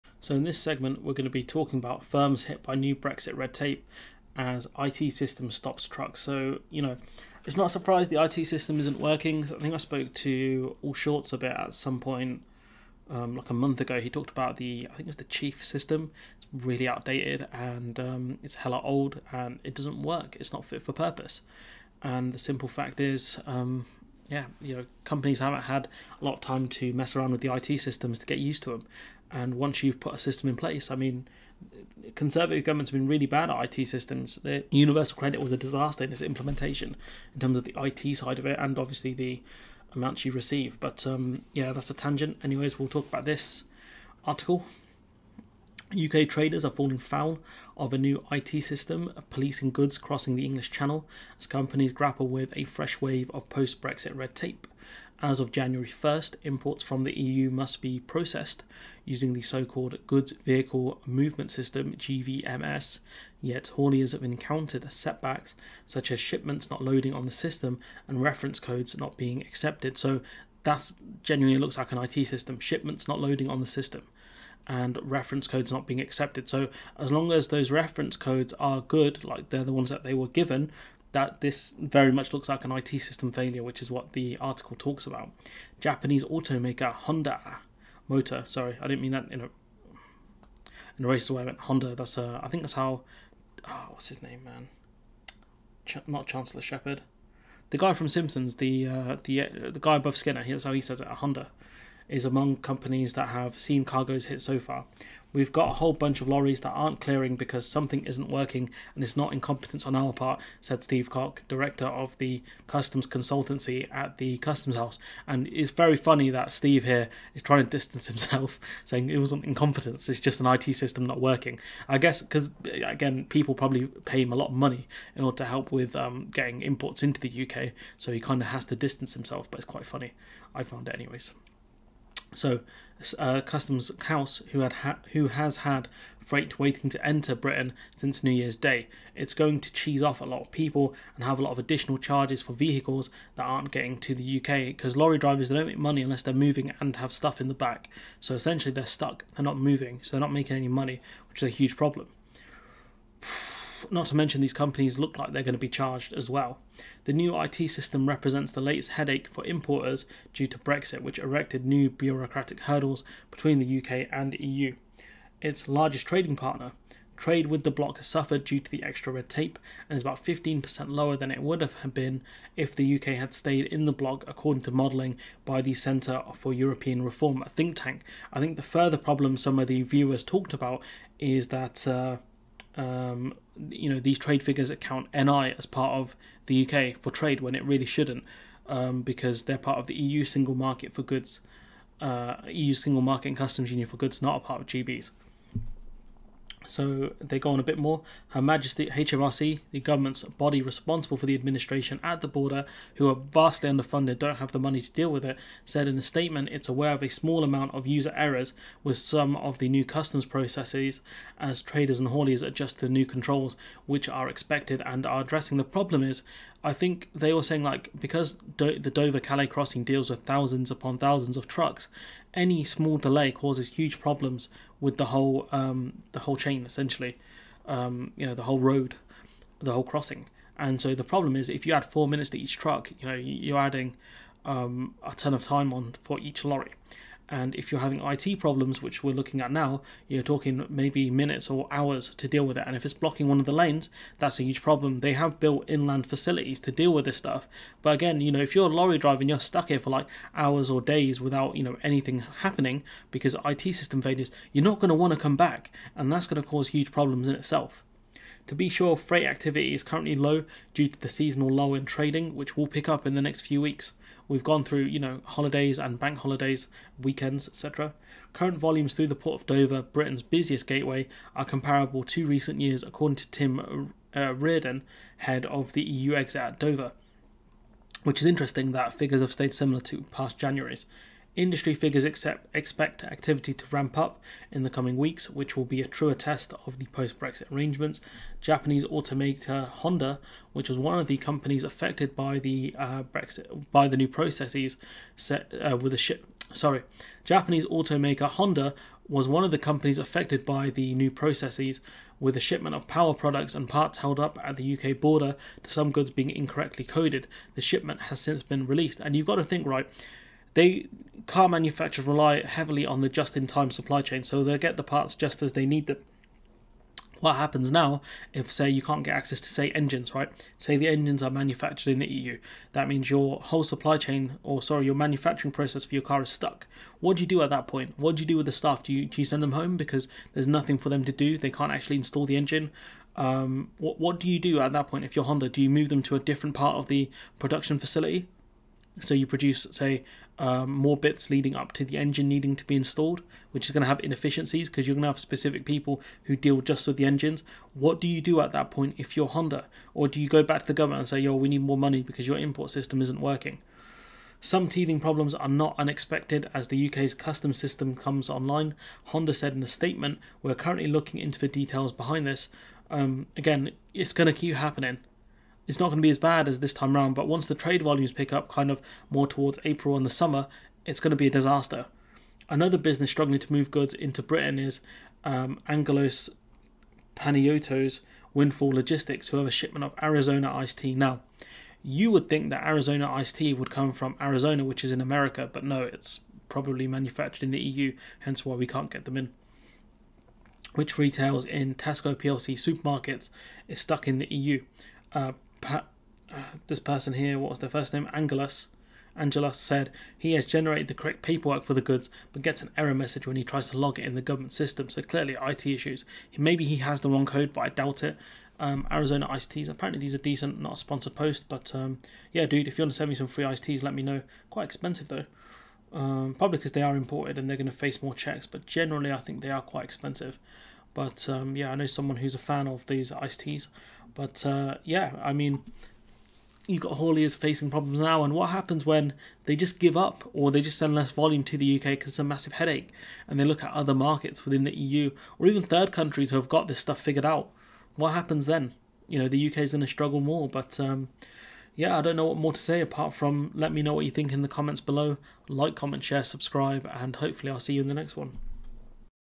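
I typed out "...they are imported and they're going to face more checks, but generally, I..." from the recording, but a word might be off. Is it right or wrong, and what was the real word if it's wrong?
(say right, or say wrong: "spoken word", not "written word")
right.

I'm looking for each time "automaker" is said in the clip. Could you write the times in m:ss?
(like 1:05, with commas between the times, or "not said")
1:26, 4:48, 4:57.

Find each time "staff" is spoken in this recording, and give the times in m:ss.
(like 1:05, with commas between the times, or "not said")
5:28.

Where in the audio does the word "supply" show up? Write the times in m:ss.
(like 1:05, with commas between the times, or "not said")
5:13, 5:23.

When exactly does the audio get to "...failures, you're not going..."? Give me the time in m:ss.
4:14.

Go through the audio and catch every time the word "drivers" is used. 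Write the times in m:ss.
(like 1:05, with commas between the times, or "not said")
2:25, 4:08.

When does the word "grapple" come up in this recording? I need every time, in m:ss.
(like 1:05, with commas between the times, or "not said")
0:51.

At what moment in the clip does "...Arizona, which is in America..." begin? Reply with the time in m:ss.
6:24.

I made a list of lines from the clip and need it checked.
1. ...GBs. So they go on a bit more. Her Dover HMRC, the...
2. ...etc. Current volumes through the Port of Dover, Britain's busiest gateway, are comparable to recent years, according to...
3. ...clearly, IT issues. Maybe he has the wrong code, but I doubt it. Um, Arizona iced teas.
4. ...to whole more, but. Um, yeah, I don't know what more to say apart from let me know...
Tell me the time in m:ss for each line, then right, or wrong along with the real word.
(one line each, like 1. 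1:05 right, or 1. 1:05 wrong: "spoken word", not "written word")
1. 3:14 wrong: "Majesty", not "Dover"
2. 4:27 right
3. 6:45 right
4. 7:19 wrong: "struggle", not "whole".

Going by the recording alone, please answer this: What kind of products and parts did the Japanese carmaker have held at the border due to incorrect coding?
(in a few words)
Power products.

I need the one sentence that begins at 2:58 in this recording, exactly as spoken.
I think the further problem some of the viewers talked about is that.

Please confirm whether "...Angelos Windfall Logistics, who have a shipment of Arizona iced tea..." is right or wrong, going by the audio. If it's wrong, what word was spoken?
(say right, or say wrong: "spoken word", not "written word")
right.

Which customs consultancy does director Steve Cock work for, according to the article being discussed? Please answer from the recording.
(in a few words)
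The Customs House.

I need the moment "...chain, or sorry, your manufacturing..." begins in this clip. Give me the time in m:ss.
5:23.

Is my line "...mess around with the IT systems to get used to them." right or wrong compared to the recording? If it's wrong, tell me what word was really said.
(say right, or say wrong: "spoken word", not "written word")
right.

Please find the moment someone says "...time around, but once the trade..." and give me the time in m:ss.
6:06.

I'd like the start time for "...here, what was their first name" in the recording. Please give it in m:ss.
6:37.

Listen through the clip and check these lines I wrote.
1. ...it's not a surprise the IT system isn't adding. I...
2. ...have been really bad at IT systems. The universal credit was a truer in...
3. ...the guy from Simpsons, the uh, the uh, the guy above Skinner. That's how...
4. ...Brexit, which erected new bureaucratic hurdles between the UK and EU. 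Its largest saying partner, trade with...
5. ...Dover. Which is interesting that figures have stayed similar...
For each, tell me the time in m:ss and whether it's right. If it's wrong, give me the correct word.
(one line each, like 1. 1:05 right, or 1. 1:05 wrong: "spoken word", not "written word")
1. 0:07 wrong: "working", not "adding"
2. 0:32 wrong: "disaster", not "truer"
3. 1:37 right
4. 2:40 wrong: "trading", not "saying"
5. 4:36 right.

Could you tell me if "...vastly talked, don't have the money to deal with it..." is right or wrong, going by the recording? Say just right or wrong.
wrong.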